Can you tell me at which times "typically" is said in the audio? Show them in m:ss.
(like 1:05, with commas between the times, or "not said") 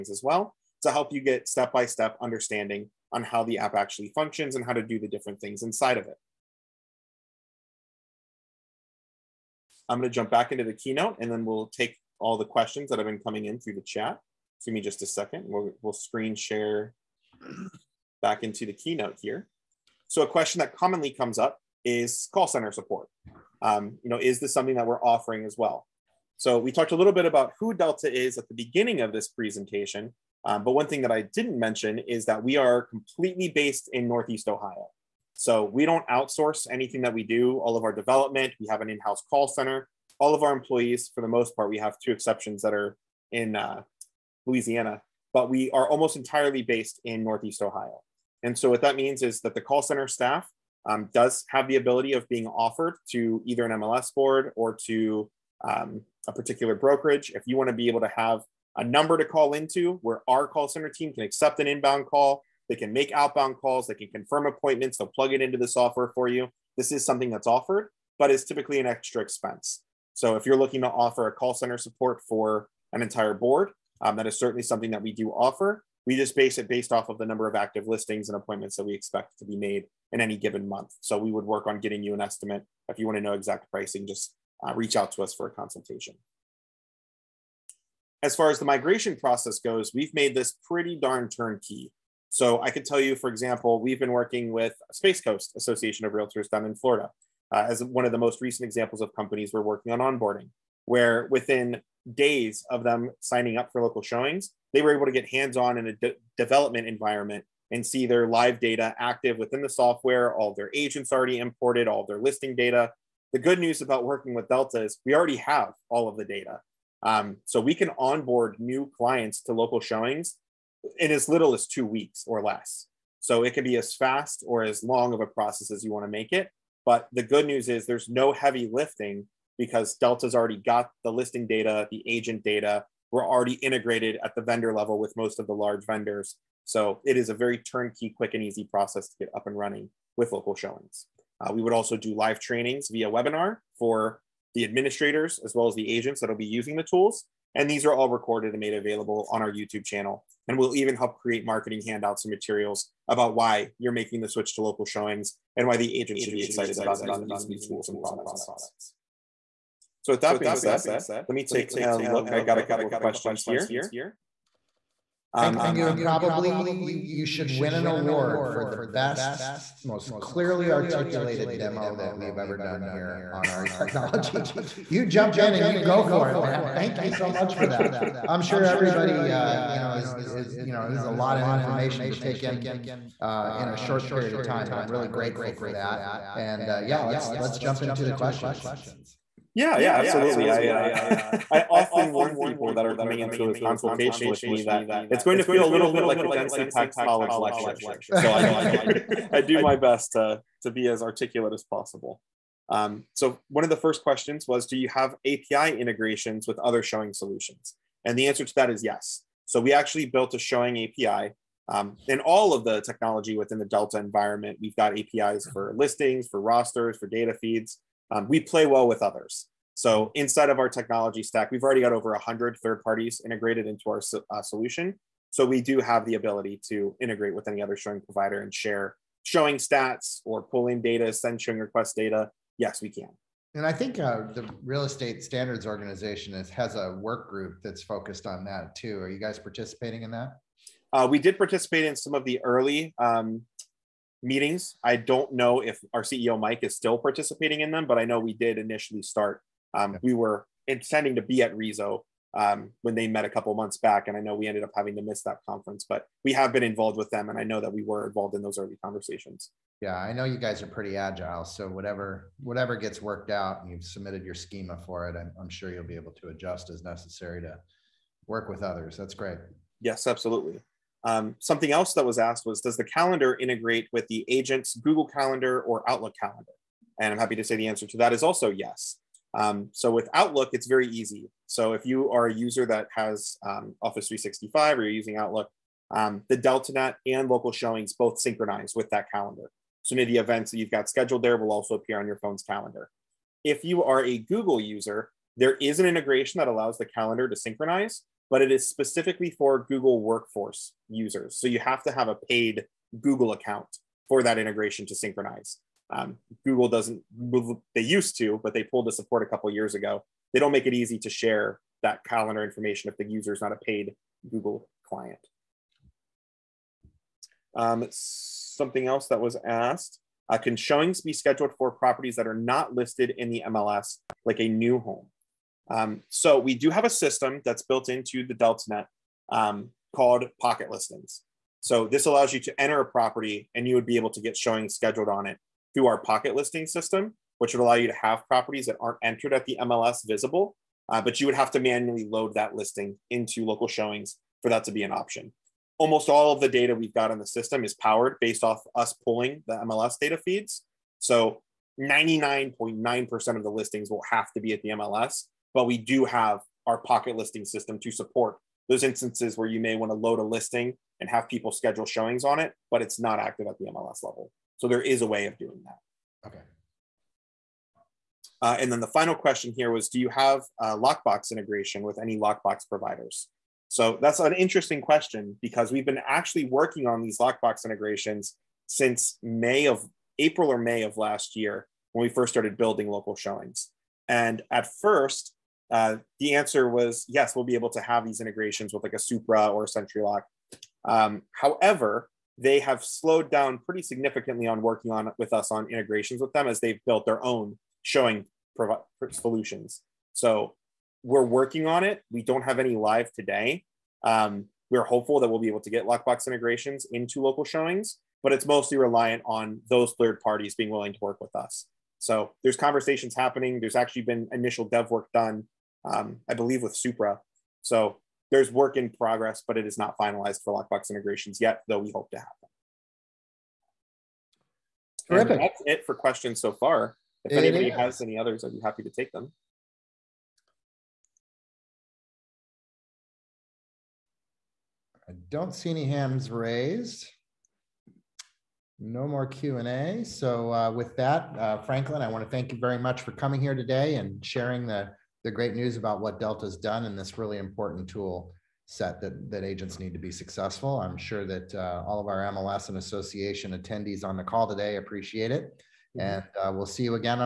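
1:08.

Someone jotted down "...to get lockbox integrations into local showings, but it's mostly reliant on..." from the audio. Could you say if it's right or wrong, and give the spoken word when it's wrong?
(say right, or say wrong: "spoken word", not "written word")
right.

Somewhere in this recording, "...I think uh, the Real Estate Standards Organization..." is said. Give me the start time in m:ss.
3:53.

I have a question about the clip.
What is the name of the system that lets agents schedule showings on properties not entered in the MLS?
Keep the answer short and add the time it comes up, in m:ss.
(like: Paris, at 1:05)
Pocket Listings, at 5:30.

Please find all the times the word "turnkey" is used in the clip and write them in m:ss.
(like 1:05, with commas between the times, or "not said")
1:31, 2:17.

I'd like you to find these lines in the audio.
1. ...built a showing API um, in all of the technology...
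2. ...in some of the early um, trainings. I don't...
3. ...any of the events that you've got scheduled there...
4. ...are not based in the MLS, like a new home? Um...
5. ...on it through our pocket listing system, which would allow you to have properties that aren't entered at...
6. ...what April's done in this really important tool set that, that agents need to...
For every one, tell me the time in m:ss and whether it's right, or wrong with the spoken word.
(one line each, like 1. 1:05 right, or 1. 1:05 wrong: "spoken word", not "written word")
1. 3:30 right
2. 4:01 wrong: "meetings", not "trainings"
3. 4:49 right
4. 5:22 wrong: "listed", not "based"
5. 5:35 right
6. 7:25 wrong: "Delta", not "April".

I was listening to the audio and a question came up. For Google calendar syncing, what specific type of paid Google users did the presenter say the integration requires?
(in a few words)
Google Workforce users.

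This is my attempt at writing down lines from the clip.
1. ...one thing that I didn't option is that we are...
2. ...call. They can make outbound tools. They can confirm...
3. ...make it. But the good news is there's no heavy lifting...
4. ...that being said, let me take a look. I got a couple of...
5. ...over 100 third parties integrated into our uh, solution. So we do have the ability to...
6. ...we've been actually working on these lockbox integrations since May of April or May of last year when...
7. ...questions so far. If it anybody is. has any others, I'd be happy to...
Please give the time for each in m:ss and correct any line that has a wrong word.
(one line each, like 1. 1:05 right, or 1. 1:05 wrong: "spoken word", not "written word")
1. 0:30 wrong: "mention", not "option"
2. 1:02 wrong: "calls", not "tools"
3. 2:06 right
4. 2:40 right
5. 3:41 right
6. 6:15 right
7. 7:05 right.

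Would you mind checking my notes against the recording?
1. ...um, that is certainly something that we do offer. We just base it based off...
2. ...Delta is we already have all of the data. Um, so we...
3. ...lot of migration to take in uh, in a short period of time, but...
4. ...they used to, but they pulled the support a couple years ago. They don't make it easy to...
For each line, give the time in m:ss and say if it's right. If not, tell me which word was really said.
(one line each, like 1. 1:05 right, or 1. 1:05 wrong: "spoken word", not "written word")
1. 1:14 right
2. 1:54 right
3. 3:01 wrong: "information", not "migration"
4. 5:07 right.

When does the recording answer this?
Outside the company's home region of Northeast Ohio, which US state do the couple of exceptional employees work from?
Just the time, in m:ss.
0:44.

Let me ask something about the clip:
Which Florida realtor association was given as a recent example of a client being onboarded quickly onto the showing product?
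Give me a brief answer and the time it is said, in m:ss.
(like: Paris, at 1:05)
Space Coast Association of Realtors, at 1:34.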